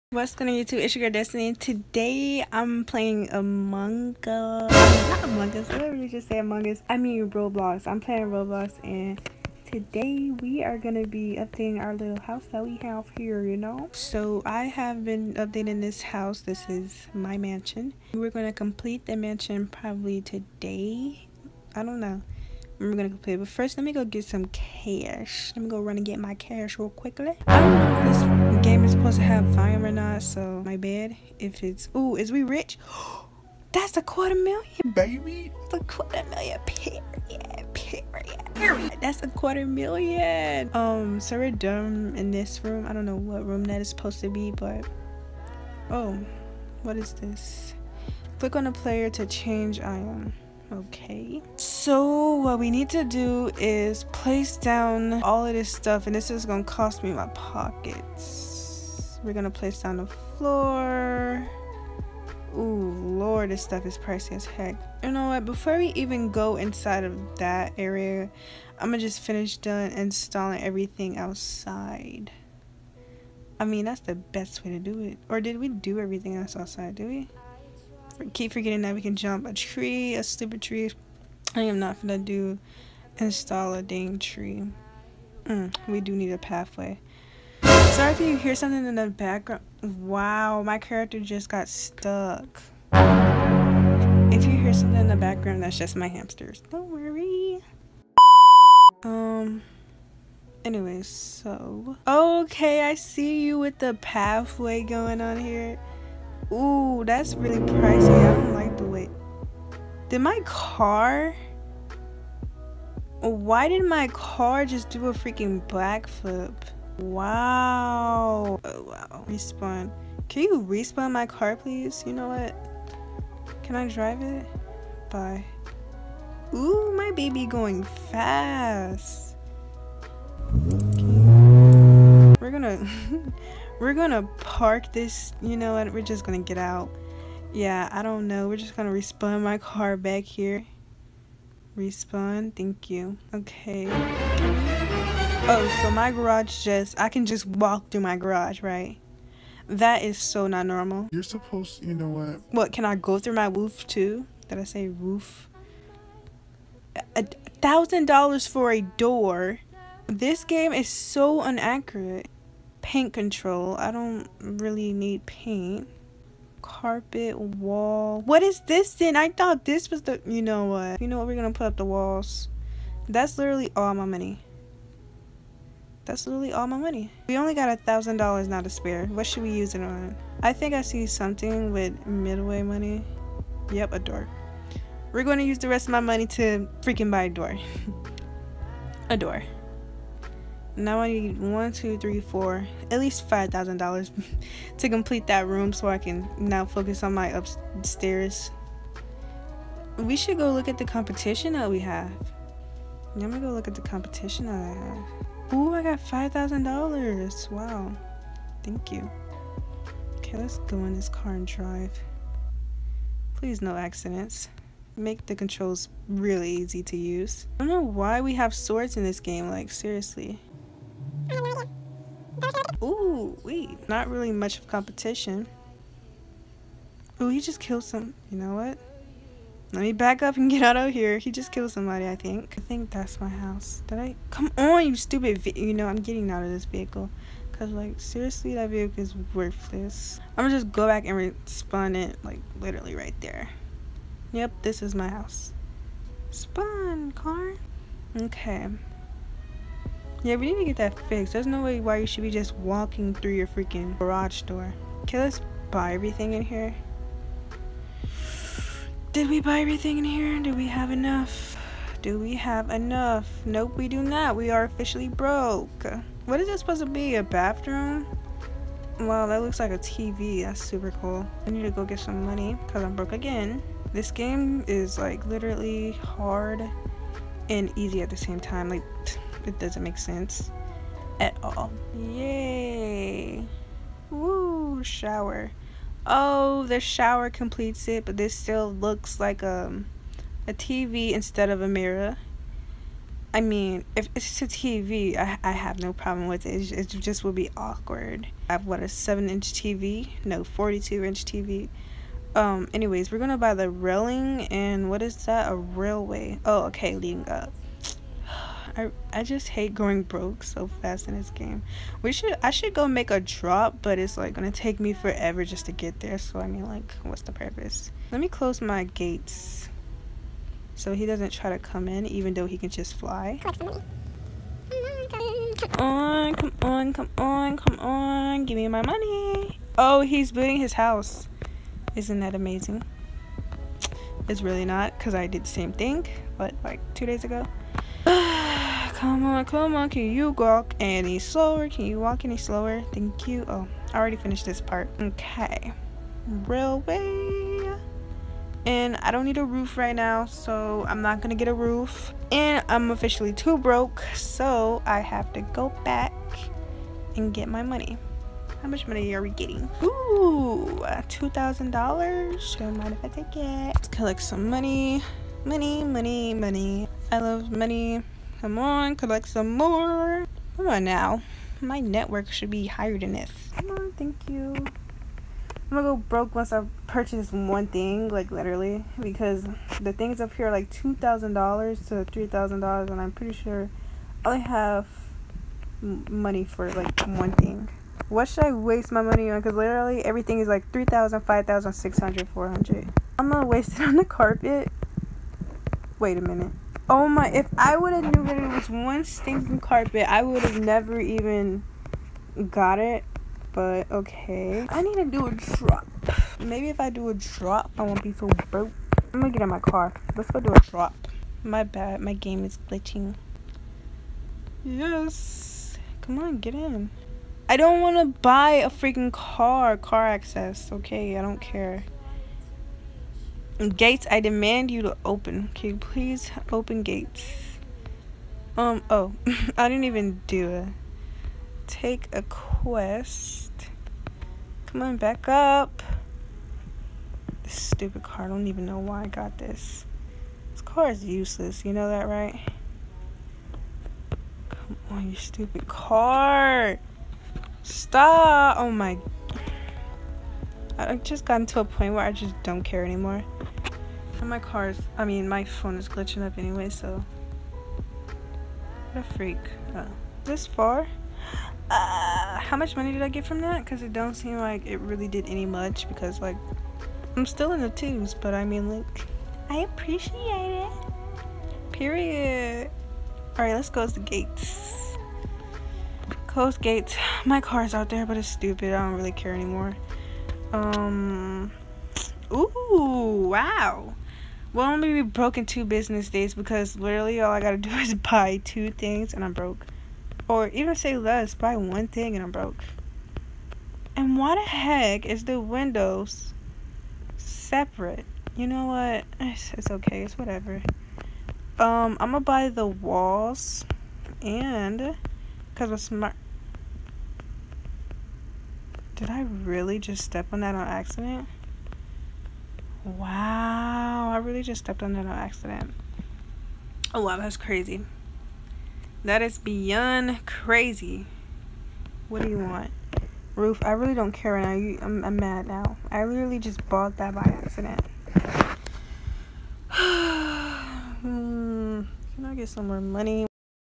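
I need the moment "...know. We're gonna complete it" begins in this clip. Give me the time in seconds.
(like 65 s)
22 s.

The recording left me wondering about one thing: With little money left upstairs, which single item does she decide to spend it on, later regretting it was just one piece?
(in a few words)
The carpet.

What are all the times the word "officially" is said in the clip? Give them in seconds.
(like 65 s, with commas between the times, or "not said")
264 s, 352 s.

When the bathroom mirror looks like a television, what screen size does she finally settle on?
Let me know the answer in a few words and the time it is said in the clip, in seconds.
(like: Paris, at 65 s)
42-inch, at 300 s.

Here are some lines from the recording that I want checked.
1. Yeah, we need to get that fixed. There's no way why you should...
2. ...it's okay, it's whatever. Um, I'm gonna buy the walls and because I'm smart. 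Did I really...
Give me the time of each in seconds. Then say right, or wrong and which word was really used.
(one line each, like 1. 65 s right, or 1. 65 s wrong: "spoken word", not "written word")
1. 250 s right
2. 499 s right.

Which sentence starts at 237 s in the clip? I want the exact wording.
Because, like, seriously, that vehicle is worthless.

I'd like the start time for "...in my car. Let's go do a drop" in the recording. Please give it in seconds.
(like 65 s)
409 s.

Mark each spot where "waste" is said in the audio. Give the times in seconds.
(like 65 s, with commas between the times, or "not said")
388 s, 393 s.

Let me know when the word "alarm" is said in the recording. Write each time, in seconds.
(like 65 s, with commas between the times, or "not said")
not said.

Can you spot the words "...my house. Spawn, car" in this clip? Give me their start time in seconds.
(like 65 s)
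244 s.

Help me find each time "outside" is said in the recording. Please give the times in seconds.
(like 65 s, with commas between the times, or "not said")
71 s, 76 s.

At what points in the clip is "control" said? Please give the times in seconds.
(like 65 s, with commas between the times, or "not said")
163 s, 215 s.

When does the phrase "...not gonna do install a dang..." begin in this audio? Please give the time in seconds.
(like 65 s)
81 s.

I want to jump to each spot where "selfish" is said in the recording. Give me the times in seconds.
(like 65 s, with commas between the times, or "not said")
not said.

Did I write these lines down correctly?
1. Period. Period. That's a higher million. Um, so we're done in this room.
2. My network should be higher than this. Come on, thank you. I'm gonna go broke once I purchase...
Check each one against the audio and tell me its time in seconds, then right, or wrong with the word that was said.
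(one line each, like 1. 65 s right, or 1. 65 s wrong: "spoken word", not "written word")
1. 37 s wrong: "quarter", not "higher"
2. 371 s right.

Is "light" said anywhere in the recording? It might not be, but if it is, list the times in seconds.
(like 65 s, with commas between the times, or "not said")
not said.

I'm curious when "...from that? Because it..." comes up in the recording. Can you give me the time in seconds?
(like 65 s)
463 s.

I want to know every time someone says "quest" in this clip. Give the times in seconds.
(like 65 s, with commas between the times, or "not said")
432 s.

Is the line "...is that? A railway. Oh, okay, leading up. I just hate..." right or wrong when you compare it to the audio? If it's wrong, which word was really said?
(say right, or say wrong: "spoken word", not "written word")
right.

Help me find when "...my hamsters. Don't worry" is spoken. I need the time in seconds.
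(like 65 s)
95 s.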